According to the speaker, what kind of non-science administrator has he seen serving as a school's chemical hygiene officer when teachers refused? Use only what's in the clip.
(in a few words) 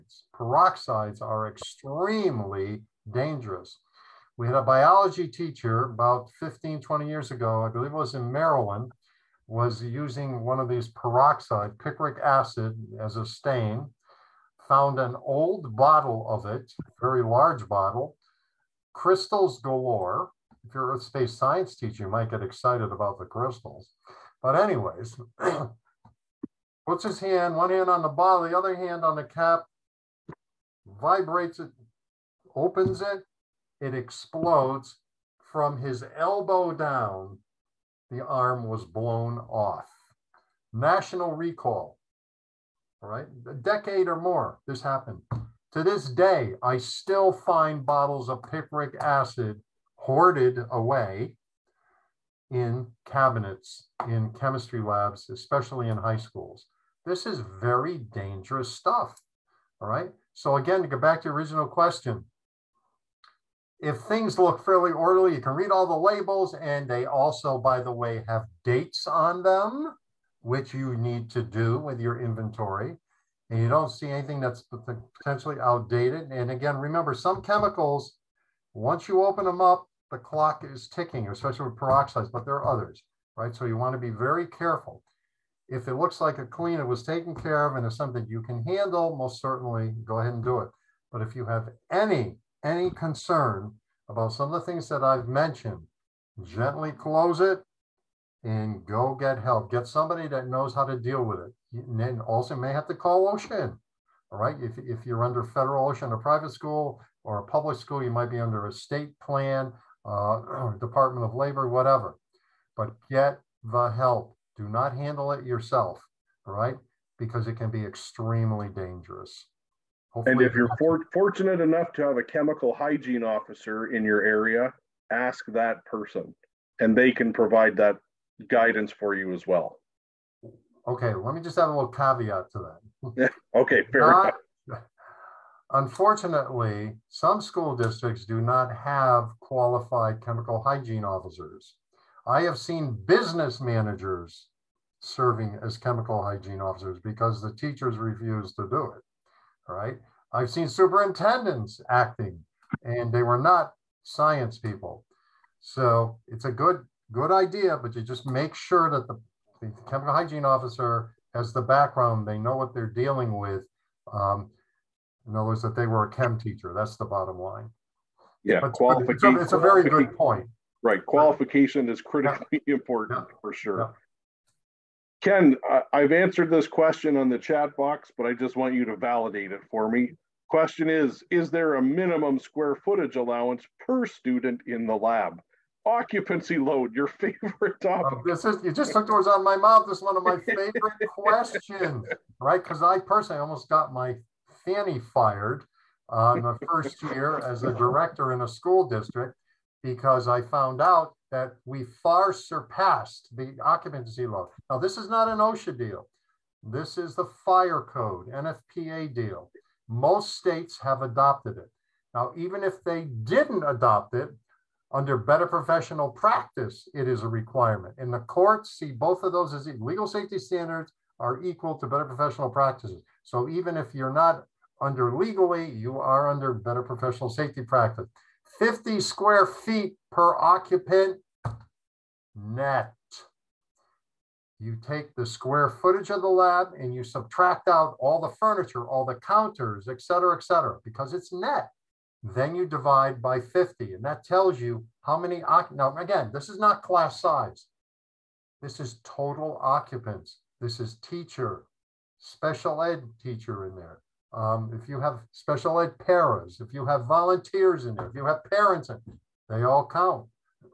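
business managers.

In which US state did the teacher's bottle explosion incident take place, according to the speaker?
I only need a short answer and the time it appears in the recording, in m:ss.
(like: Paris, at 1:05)
Maryland, at 0:08.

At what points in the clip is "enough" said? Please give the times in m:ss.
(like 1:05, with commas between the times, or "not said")
2:01, 2:14.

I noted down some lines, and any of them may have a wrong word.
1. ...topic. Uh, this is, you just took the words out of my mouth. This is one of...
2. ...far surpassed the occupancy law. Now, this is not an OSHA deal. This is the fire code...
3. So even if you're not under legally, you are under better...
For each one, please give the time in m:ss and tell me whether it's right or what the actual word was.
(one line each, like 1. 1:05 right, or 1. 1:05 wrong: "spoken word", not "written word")
1. 3:07 right
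2. 3:22 right
3. 3:43 right.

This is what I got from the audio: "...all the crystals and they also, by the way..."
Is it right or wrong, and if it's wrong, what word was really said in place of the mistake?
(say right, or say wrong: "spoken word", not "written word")
wrong: "labels", not "crystals".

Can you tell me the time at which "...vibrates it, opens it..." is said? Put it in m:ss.
0:30.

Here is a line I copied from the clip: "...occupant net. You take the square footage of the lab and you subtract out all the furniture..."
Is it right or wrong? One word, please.
right.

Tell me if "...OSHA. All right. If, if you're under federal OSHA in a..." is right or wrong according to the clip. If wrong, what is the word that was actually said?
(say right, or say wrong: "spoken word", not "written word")
right.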